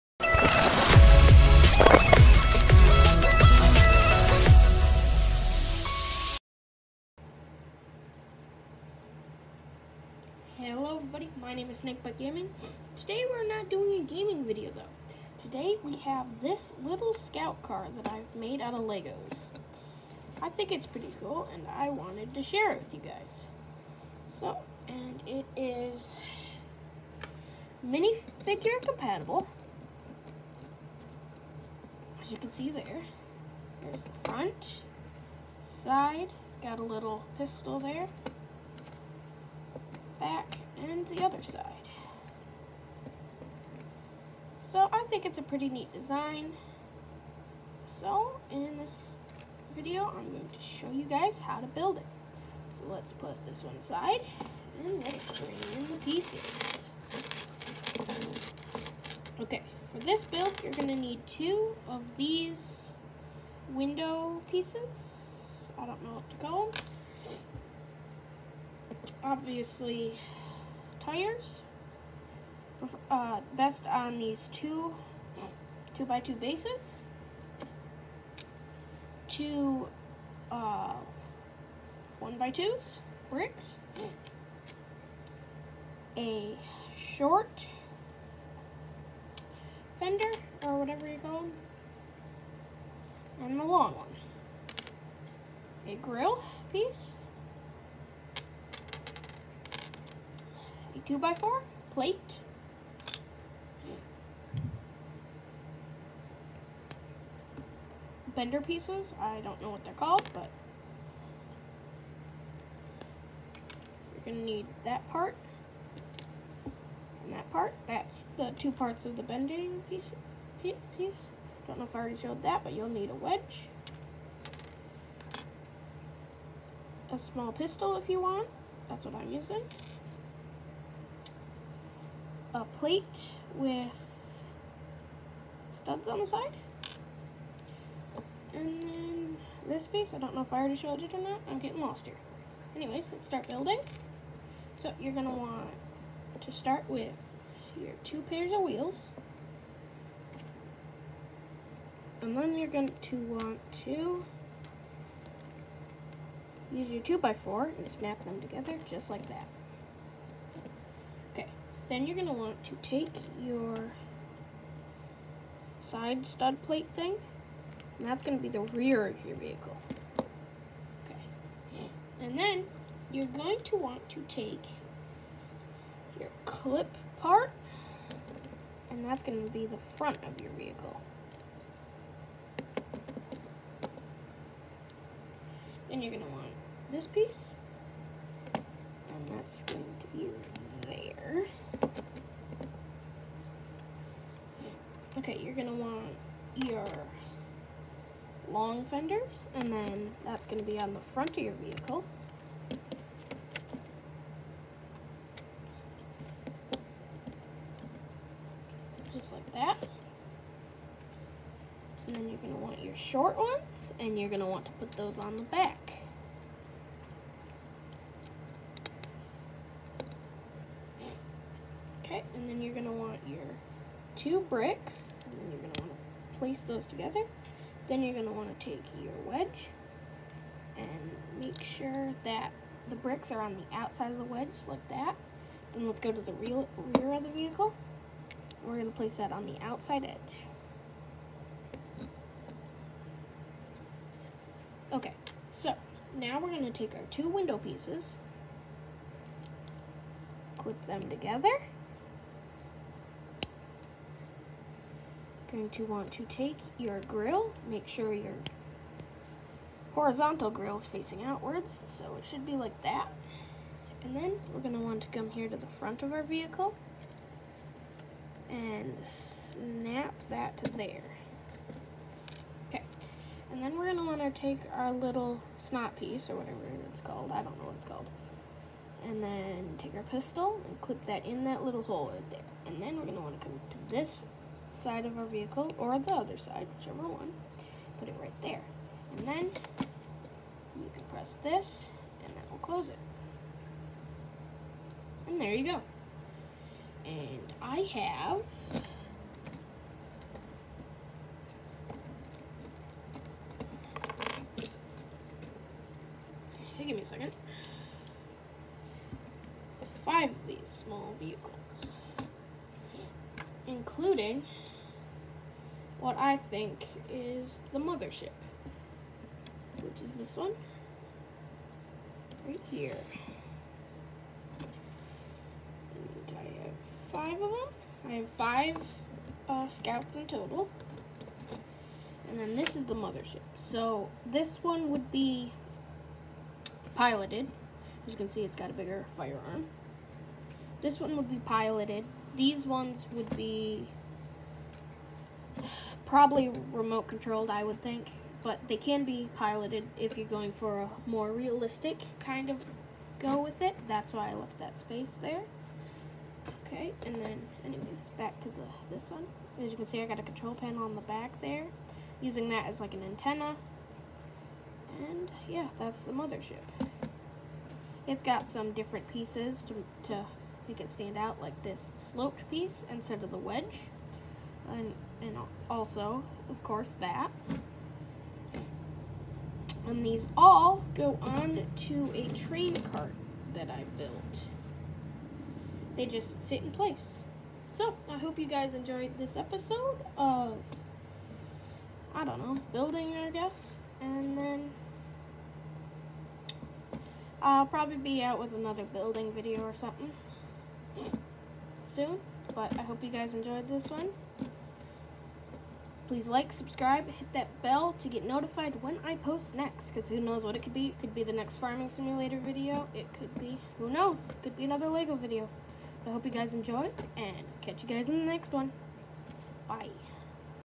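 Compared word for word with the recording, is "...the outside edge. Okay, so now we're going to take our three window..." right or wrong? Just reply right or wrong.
wrong.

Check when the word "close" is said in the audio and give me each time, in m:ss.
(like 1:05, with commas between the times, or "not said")
4:52.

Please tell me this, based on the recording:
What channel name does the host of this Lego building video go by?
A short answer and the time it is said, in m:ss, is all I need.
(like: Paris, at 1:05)
Snake Bite Gaming, at 0:11.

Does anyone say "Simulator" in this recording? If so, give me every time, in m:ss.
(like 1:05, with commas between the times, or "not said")
6:51.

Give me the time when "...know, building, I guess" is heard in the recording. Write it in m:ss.
6:32.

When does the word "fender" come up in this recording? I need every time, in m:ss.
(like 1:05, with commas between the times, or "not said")
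1:29, 3:18.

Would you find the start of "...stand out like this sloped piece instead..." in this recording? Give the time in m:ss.
6:10.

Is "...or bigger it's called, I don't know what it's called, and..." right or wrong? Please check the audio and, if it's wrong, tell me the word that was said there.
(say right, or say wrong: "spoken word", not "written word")
wrong: "whatever", not "bigger".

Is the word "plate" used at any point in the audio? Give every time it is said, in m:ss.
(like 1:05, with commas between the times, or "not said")
1:41, 2:12, 2:46.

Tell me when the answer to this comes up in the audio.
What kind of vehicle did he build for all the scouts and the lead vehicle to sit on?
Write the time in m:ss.
6:22.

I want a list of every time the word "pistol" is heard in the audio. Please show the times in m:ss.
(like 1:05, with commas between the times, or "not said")
0:37, 2:07, 4:40.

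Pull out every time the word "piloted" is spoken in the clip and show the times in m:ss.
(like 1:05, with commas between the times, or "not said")
5:36, 5:41, 5:49.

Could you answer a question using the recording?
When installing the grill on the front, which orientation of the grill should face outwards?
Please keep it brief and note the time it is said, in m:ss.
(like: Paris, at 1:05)
Horizontal, at 4:19.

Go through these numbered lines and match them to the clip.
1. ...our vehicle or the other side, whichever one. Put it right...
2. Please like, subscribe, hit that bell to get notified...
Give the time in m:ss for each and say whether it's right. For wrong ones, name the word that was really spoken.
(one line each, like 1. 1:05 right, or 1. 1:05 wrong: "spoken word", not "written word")
1. 4:45 right
2. 6:46 right.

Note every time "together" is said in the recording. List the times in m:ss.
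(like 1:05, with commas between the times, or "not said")
2:38, 3:46, 4:11.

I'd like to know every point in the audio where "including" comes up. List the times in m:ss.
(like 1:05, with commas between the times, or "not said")
5:13.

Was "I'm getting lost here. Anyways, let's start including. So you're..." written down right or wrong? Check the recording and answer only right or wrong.
wrong.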